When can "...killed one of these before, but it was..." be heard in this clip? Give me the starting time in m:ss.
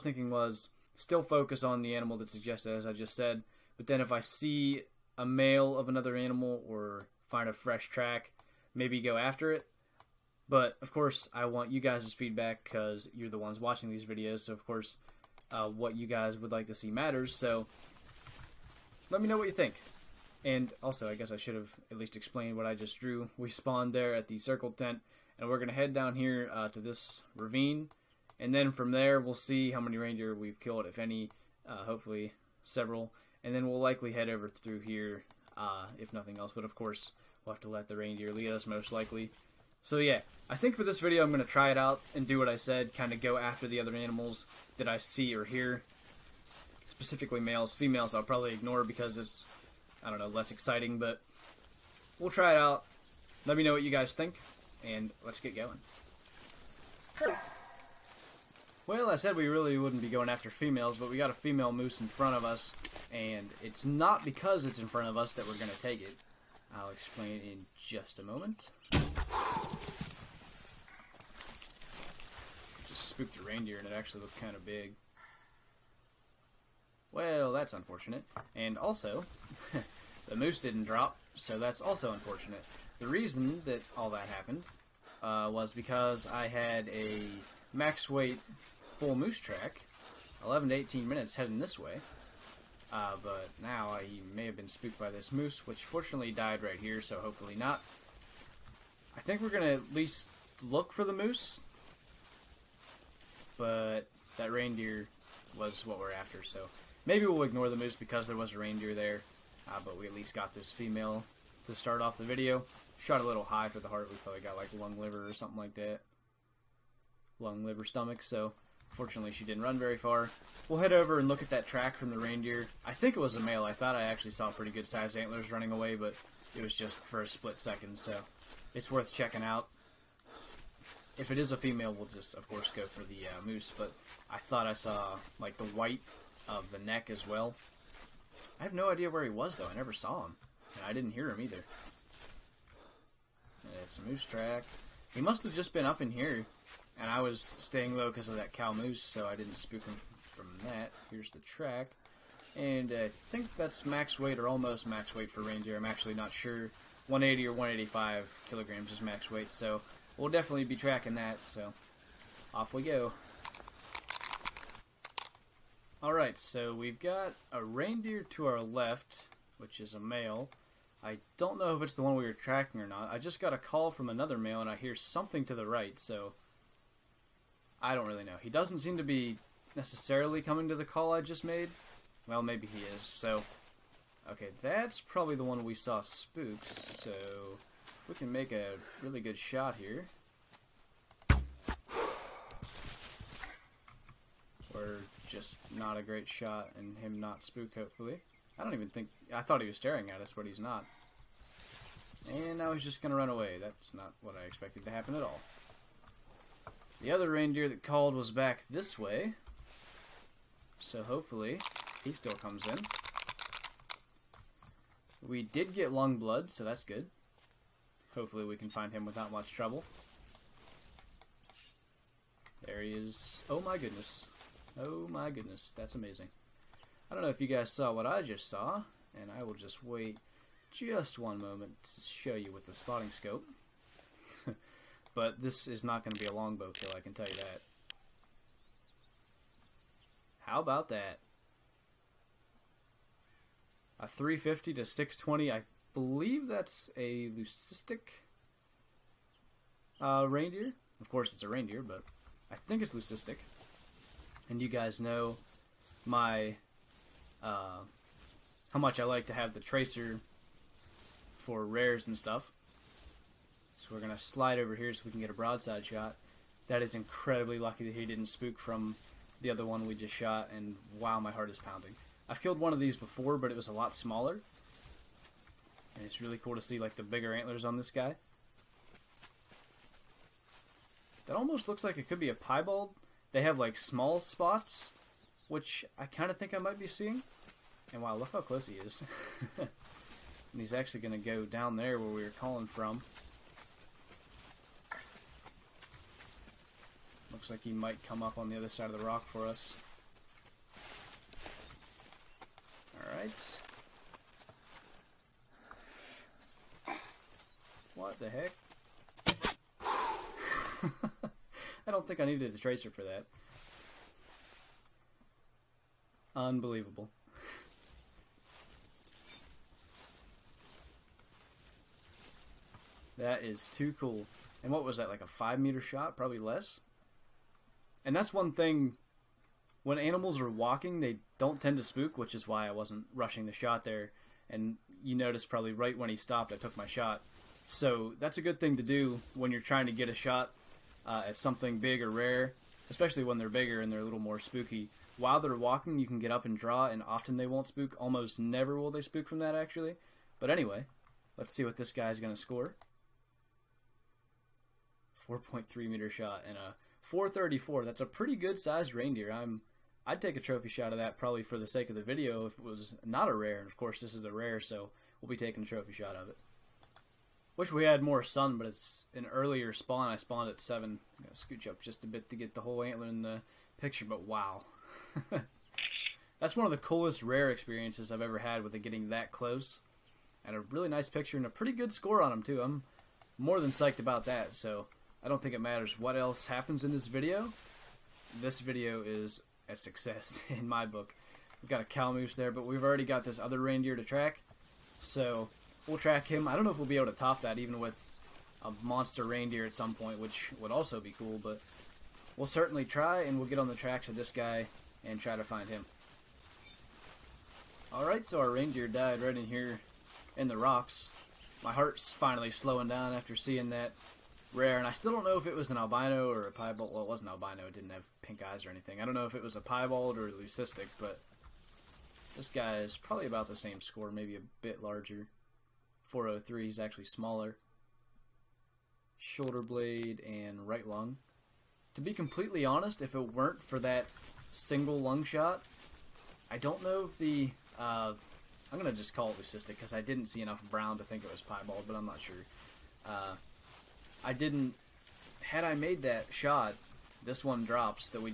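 4:32.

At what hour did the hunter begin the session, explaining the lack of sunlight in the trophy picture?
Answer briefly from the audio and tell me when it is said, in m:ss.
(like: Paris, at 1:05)
7, at 6:10.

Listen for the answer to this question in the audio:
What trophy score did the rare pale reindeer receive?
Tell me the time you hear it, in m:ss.
5:57.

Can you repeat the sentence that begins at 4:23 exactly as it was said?
So we're gonna slide over here so we can get a broadside shot.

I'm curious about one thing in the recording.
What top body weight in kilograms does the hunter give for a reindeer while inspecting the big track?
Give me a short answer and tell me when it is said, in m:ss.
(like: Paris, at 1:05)
180 or 185, at 2:37.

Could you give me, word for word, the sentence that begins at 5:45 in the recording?
While they're walking, you can get up and draw, and often they won't spook.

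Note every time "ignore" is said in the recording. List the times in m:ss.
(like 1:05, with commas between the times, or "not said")
0:48, 1:47.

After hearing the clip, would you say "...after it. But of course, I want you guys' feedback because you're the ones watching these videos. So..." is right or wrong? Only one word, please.
right.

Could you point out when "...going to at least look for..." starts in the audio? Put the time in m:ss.
1:39.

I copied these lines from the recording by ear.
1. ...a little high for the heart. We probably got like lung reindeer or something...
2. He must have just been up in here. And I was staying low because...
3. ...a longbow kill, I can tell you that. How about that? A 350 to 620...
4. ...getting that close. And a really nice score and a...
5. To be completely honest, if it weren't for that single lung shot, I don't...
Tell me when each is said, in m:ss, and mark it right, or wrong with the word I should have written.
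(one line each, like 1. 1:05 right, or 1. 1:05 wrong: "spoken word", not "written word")
1. 1:53 wrong: "liver", not "reindeer"
2. 2:25 right
3. 3:56 right
4. 6:18 wrong: "picture", not "score"
5. 7:11 right.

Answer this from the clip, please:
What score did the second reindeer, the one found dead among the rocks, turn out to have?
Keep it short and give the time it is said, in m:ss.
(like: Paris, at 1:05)
403, at 7:06.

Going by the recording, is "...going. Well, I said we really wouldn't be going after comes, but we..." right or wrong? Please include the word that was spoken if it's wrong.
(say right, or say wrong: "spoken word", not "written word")
wrong: "females", not "comes".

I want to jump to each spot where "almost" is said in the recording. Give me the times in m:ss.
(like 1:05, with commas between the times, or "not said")
2:34, 4:41, 5:47.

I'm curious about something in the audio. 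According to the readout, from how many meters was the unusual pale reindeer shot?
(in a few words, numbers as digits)
4.3 meters.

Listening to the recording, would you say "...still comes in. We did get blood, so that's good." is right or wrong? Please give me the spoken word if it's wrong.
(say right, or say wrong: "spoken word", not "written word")
right.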